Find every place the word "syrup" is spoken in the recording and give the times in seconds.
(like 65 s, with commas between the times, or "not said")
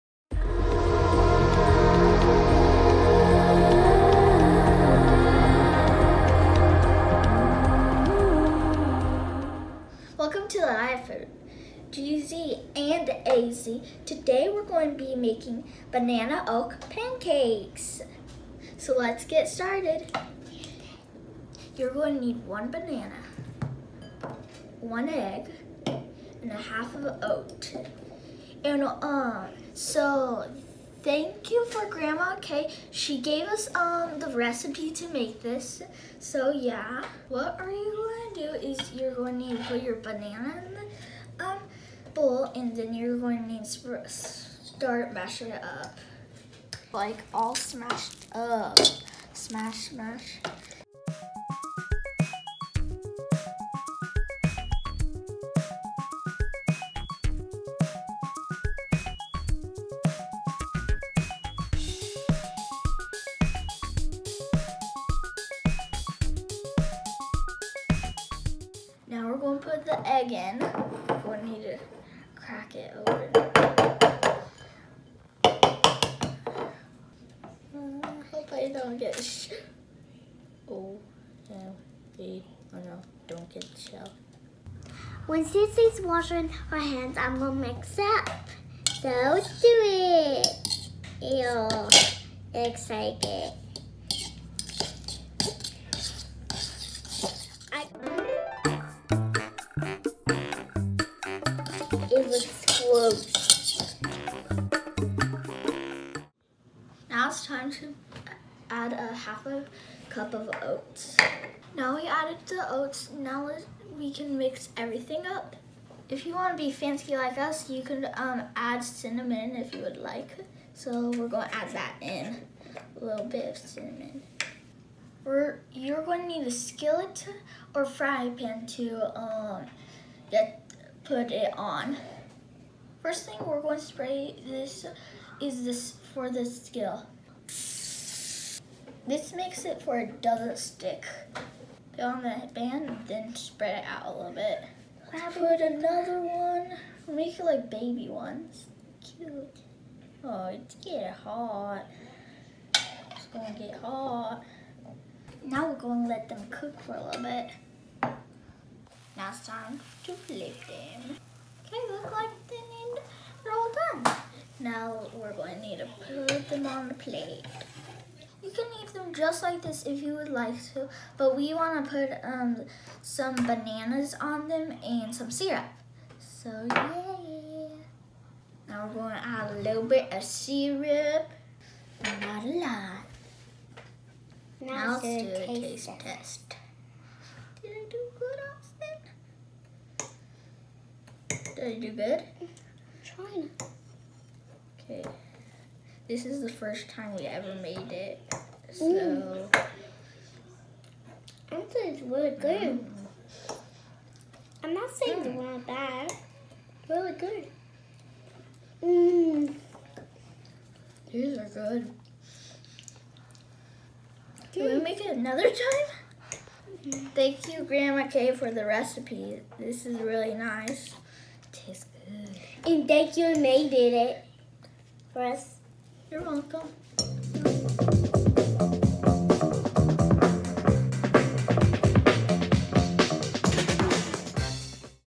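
175 s, 180 s.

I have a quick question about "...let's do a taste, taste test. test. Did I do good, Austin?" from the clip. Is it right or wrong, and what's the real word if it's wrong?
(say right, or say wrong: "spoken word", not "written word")
right.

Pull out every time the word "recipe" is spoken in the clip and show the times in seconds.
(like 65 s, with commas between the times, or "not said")
34 s, 218 s.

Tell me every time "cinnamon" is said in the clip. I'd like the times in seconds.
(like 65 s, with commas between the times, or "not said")
118 s, 123 s.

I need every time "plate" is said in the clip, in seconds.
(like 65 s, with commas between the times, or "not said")
166 s.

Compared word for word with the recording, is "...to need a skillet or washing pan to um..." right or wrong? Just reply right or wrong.
wrong.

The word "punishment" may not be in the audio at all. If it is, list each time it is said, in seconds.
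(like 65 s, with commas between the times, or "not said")
not said.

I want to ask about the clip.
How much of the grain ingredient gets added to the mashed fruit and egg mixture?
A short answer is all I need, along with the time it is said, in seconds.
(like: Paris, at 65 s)
half a cup, at 108 s.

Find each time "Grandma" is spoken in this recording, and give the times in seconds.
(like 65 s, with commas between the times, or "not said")
31 s, 217 s.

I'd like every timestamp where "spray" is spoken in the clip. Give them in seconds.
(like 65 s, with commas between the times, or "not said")
133 s.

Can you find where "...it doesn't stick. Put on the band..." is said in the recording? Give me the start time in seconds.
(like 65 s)
139 s.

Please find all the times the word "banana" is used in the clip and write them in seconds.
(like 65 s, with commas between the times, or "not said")
15 s, 22 s, 39 s, 173 s.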